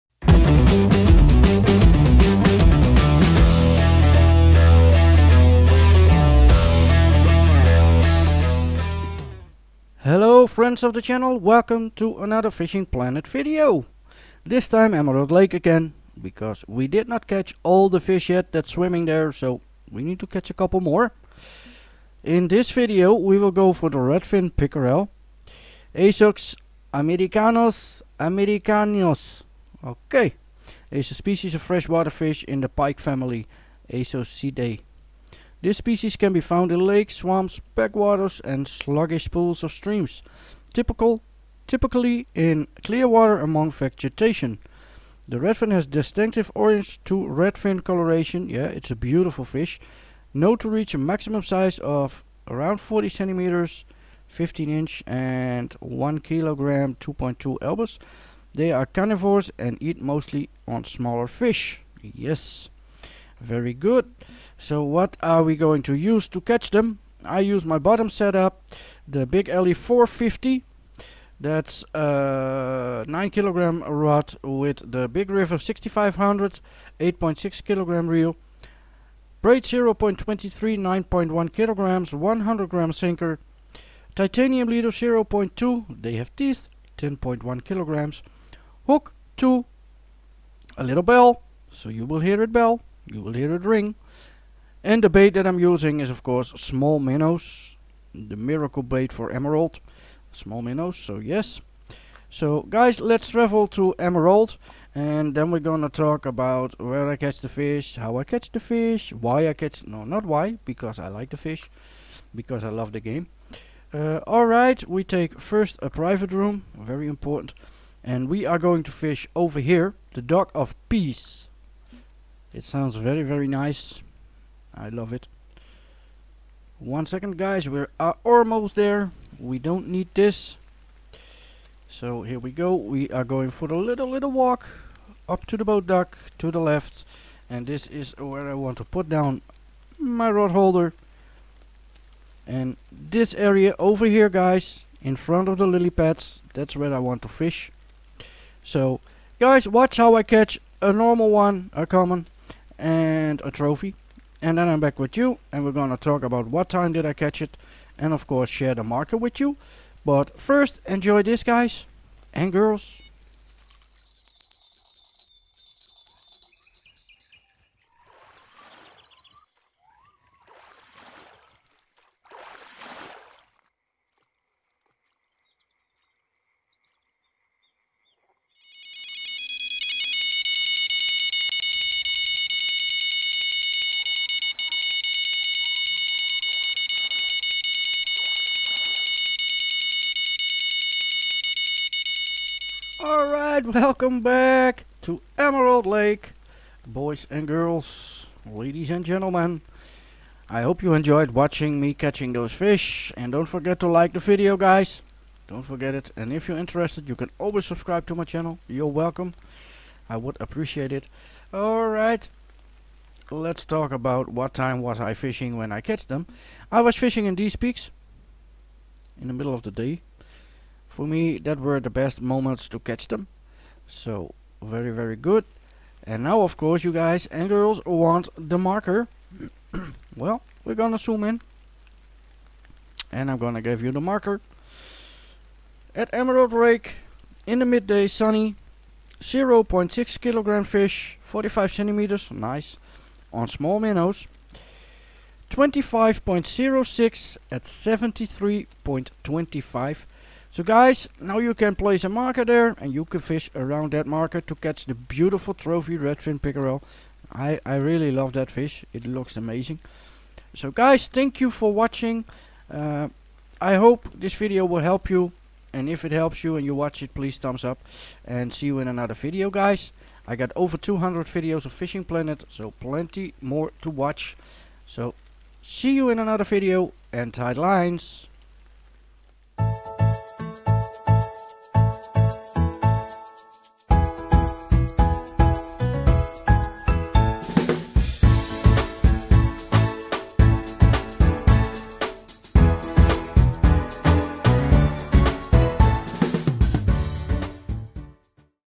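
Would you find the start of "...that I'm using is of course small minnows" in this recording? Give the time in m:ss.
1:35.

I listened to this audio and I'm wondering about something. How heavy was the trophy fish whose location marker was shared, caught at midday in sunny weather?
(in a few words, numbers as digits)
0.6 kilograms.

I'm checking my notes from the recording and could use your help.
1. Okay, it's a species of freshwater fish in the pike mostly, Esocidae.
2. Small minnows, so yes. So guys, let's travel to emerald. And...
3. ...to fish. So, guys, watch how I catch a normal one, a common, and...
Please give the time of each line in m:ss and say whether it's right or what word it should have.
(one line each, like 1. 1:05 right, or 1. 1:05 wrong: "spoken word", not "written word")
1. 0:29 wrong: "family", not "mostly"
2. 1:40 right
3. 2:27 right.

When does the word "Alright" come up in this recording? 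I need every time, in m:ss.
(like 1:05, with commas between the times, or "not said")
1:54, 3:13, 3:31.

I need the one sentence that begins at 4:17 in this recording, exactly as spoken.
I, I really love that fish, it looks amazing.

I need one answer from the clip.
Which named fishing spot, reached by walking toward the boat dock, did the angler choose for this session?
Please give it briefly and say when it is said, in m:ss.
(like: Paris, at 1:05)
Dock of Peace, at 2:00.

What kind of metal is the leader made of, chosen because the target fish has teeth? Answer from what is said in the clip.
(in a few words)
Titanium.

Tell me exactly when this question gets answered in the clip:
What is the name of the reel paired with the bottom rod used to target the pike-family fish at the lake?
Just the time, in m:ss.
1:15.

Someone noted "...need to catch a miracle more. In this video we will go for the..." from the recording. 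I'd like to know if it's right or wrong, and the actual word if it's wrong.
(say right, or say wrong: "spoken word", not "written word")
wrong: "couple", not "miracle".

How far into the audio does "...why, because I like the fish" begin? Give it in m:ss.
1:50.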